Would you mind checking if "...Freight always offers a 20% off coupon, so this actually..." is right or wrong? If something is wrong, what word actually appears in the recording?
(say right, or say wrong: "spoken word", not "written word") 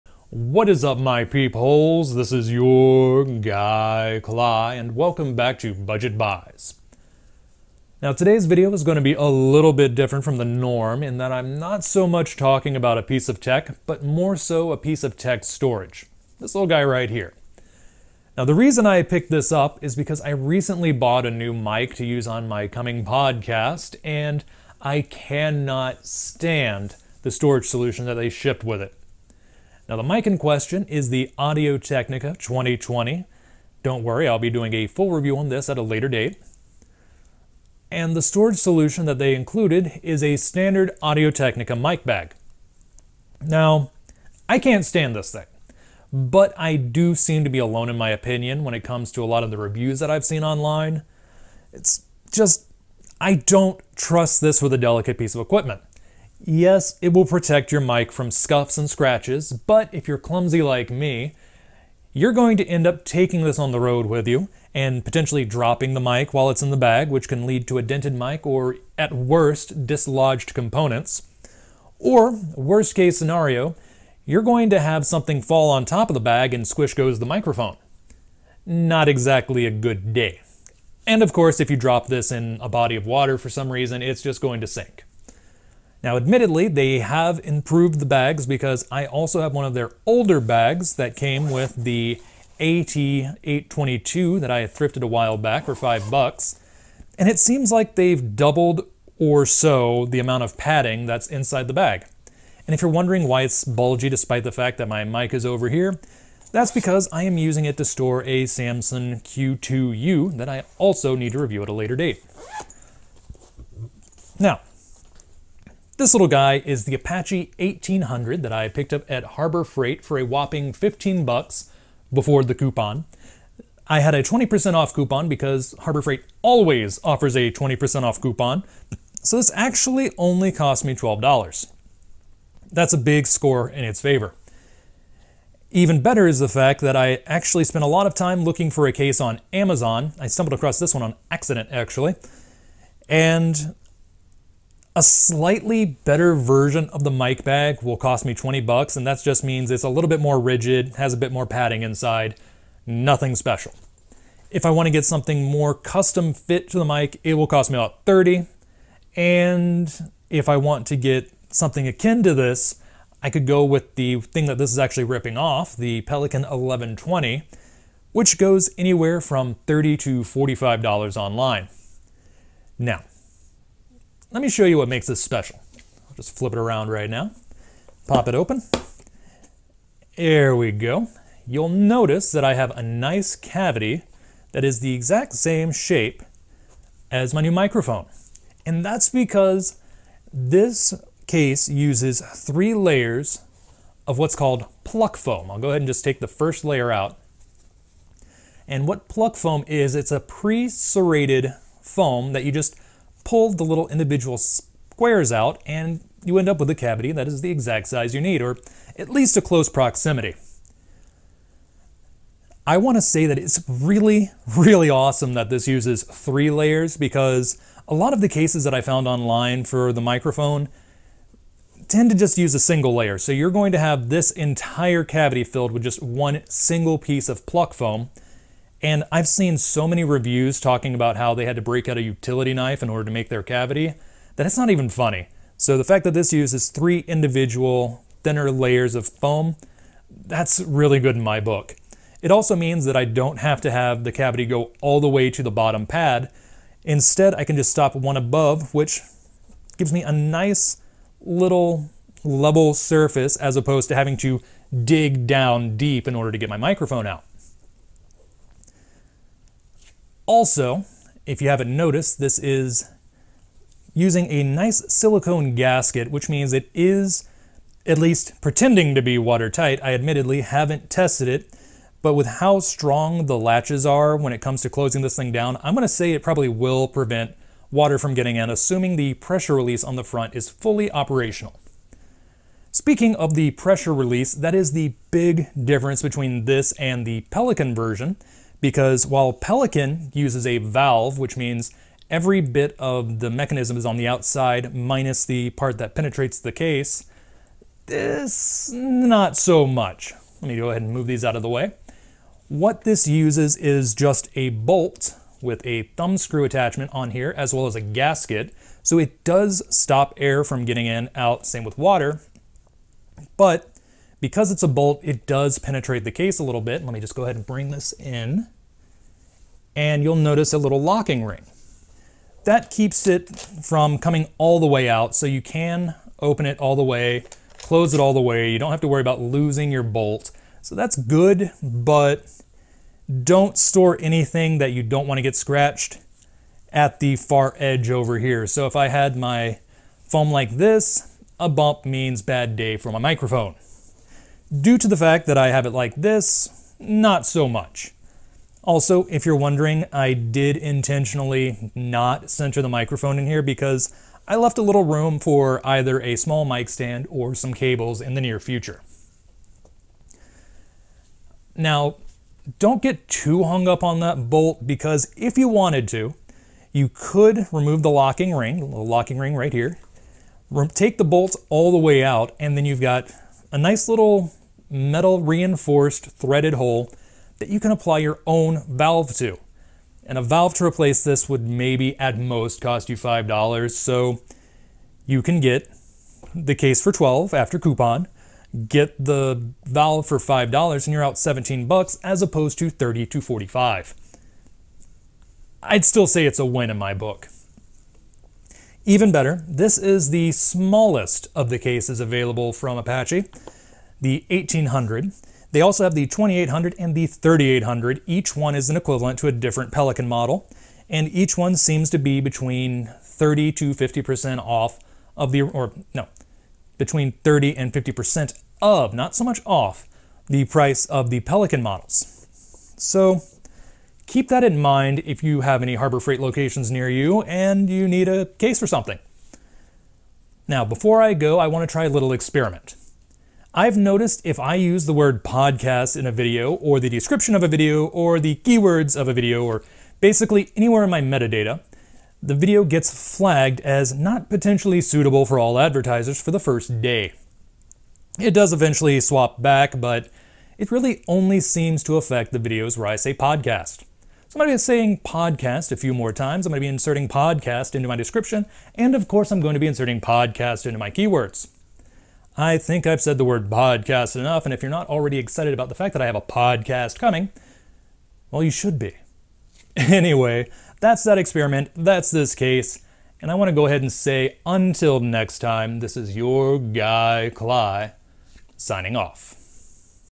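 right.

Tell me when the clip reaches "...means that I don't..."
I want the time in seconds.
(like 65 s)
242 s.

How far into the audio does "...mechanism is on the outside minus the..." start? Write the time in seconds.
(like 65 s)
293 s.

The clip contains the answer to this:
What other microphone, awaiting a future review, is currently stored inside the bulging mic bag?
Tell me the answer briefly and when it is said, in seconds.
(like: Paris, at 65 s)
Samson Q2U, at 108 s.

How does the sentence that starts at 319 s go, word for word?
And you'll notice a little locking ring.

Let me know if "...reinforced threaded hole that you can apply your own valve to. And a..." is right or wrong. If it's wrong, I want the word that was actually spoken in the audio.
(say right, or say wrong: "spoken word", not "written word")
right.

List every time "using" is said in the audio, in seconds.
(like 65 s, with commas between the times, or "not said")
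107 s, 263 s.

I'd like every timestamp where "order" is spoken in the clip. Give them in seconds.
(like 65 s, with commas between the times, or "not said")
232 s, 256 s.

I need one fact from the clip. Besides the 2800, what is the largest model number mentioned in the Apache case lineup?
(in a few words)
3800.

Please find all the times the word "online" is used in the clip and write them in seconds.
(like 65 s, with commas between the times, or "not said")
50 s, 171 s, 219 s.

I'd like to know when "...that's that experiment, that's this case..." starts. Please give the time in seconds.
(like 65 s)
470 s.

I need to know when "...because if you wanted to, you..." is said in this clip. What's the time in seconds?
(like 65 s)
364 s.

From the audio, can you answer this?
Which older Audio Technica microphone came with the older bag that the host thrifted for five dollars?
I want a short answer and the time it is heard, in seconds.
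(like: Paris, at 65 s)
AT822, at 92 s.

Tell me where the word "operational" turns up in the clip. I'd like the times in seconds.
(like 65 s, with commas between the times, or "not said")
280 s.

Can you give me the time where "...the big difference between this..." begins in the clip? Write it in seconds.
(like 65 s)
284 s.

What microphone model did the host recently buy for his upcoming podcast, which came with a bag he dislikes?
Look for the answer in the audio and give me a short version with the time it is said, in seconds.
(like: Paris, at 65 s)
Audio Technica 2020, at 31 s.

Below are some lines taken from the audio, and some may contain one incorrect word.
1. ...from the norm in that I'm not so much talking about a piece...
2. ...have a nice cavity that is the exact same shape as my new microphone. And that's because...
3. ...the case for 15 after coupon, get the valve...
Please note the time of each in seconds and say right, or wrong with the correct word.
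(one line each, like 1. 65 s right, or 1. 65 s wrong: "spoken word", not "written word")
1. 10 s right
2. 182 s right
3. 386 s wrong: "12", not "15".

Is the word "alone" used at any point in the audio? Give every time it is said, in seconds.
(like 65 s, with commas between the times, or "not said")
47 s.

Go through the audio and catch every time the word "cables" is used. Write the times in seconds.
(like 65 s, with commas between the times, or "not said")
357 s.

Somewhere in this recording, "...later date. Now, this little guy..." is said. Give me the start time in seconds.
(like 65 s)
111 s.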